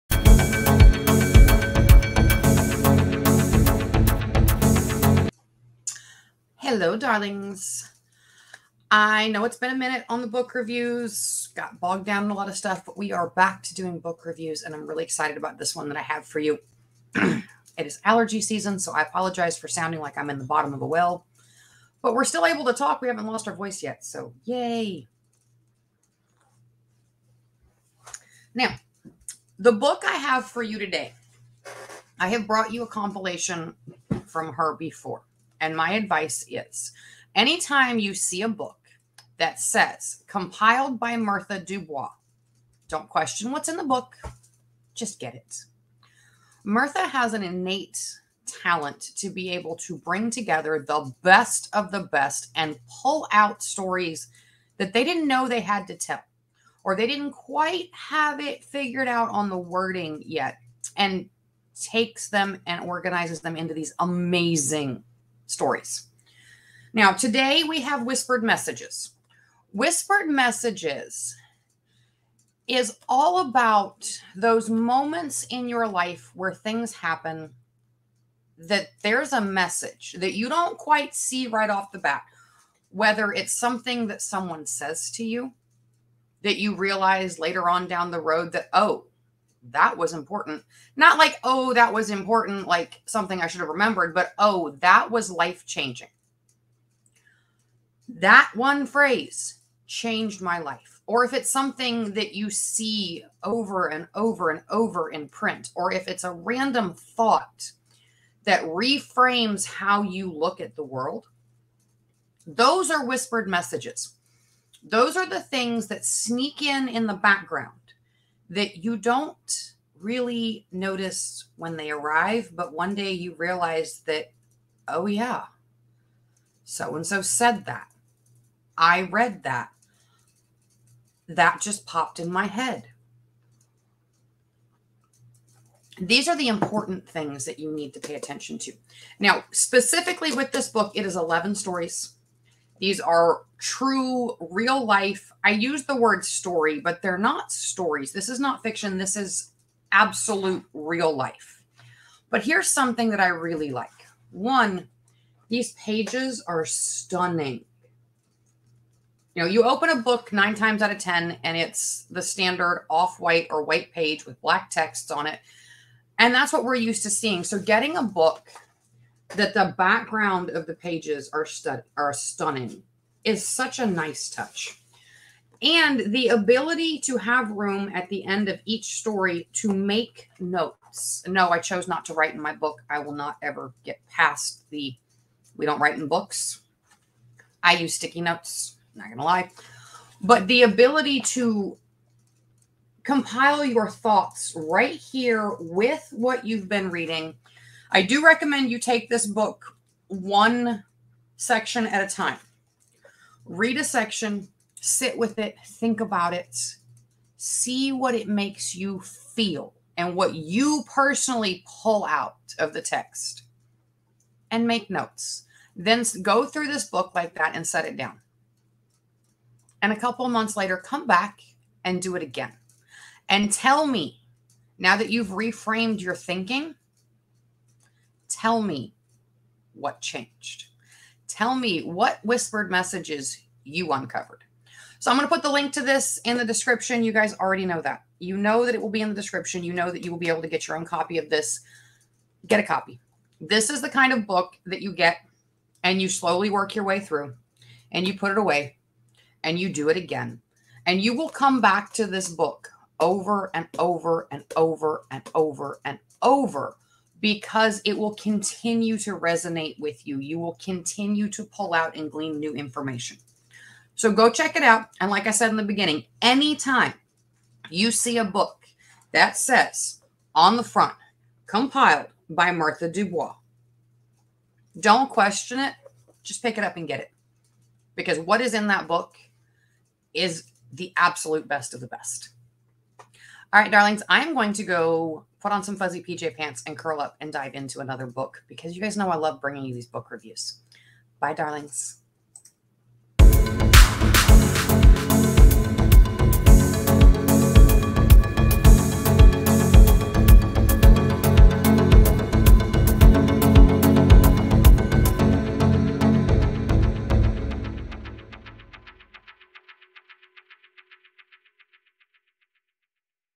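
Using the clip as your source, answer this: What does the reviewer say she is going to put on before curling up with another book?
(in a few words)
Fuzzy PJ pants.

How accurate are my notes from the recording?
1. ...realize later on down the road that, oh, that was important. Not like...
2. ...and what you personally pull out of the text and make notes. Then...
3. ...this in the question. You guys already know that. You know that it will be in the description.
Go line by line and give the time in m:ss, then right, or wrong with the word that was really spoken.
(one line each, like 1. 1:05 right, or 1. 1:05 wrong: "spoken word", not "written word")
1. 1:26 right
2. 3:29 right
3. 3:55 wrong: "description", not "question".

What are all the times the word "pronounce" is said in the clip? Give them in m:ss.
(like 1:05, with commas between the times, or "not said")
not said.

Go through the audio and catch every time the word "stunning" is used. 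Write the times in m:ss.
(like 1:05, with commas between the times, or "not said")
2:36, 2:52.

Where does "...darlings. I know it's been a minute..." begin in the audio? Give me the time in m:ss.
0:06.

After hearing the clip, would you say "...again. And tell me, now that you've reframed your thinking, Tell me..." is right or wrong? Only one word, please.
right.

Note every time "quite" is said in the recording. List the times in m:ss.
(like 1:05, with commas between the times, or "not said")
0:57, 1:20.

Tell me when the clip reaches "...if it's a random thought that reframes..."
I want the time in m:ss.
1:45.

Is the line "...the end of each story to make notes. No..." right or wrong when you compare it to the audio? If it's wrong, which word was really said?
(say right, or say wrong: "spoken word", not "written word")
right.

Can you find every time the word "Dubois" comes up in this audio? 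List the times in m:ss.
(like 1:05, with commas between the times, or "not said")
0:41, 4:32.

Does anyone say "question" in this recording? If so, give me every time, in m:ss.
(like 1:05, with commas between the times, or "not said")
0:43, 4:35.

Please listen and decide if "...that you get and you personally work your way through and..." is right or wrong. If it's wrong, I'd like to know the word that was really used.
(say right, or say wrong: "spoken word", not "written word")
wrong: "slowly", not "personally".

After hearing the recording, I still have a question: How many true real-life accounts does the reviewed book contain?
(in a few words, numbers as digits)
11.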